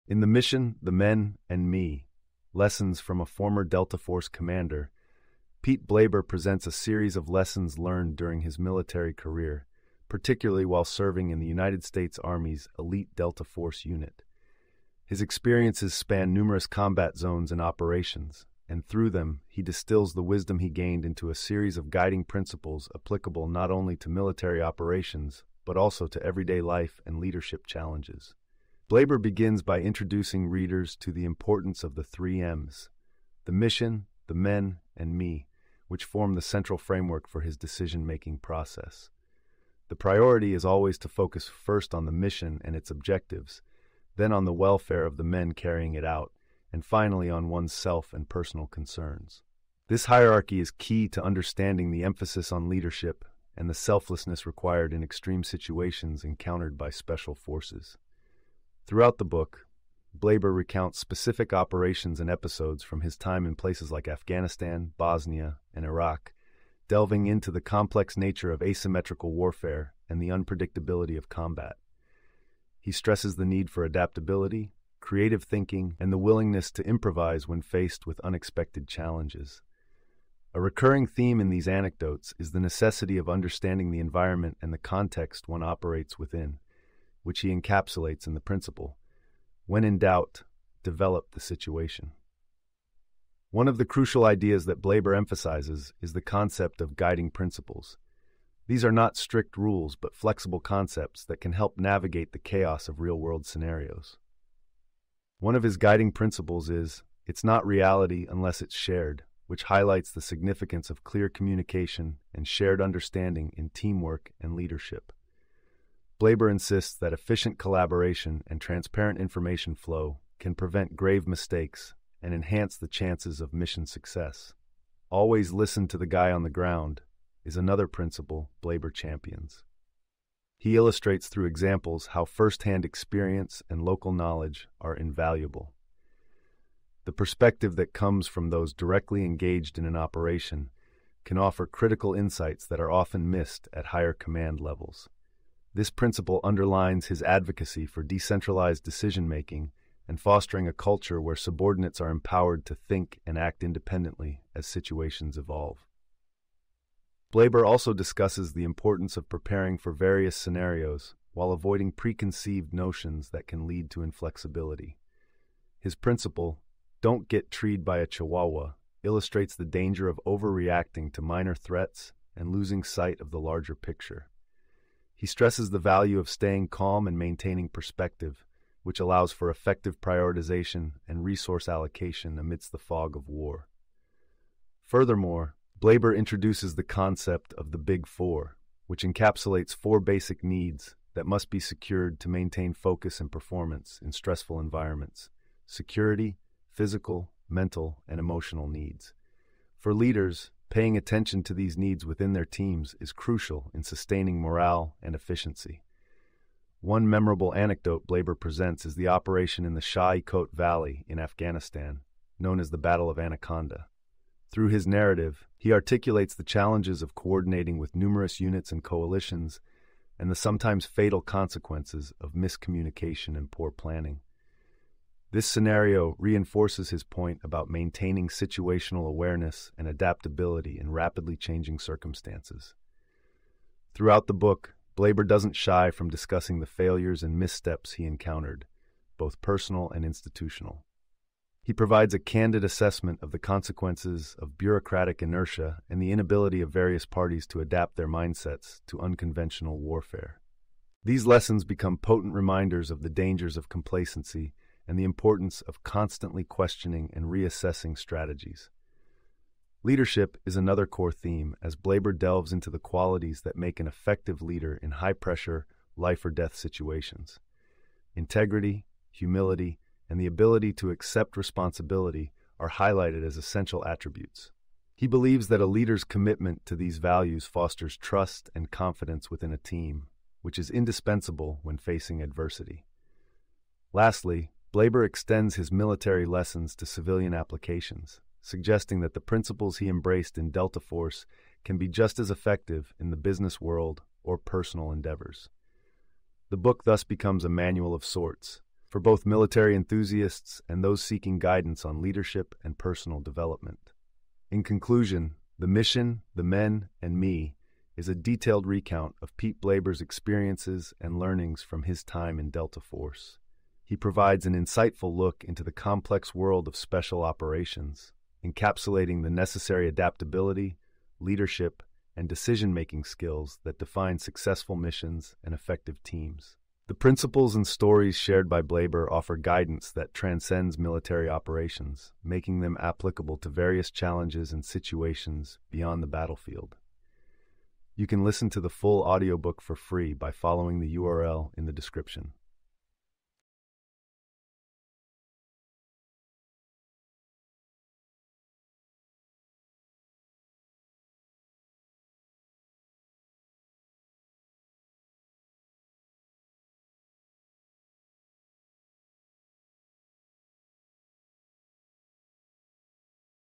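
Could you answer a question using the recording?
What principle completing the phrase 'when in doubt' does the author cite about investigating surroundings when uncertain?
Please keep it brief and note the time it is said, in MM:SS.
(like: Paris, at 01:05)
Develop the situation, at 01:30.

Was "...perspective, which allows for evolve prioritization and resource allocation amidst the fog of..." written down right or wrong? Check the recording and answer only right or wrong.
wrong.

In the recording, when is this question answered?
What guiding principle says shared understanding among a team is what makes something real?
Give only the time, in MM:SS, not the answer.
01:47.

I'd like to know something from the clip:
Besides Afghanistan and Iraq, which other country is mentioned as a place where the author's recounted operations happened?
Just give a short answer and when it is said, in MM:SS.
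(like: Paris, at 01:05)
Bosnia, at 01:04.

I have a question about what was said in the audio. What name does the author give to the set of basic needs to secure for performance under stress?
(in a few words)
The Big Four.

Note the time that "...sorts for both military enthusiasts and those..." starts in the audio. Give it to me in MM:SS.
04:58.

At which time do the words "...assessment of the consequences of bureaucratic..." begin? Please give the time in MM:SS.
04:02.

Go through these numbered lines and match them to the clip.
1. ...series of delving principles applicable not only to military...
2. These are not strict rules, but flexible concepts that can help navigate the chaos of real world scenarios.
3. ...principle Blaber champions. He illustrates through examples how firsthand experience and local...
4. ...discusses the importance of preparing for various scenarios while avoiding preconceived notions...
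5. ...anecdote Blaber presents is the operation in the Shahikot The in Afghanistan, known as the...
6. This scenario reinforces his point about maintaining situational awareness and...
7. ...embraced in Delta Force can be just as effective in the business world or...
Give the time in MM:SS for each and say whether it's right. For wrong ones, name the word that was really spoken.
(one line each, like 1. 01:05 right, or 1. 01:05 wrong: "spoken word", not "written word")
1. 00:21 wrong: "guiding", not "delving"
2. 01:38 right
3. 02:07 right
4. 02:37 right
5. 03:27 wrong: "Valley", not "The"
6. 03:45 right
7. 04:49 right.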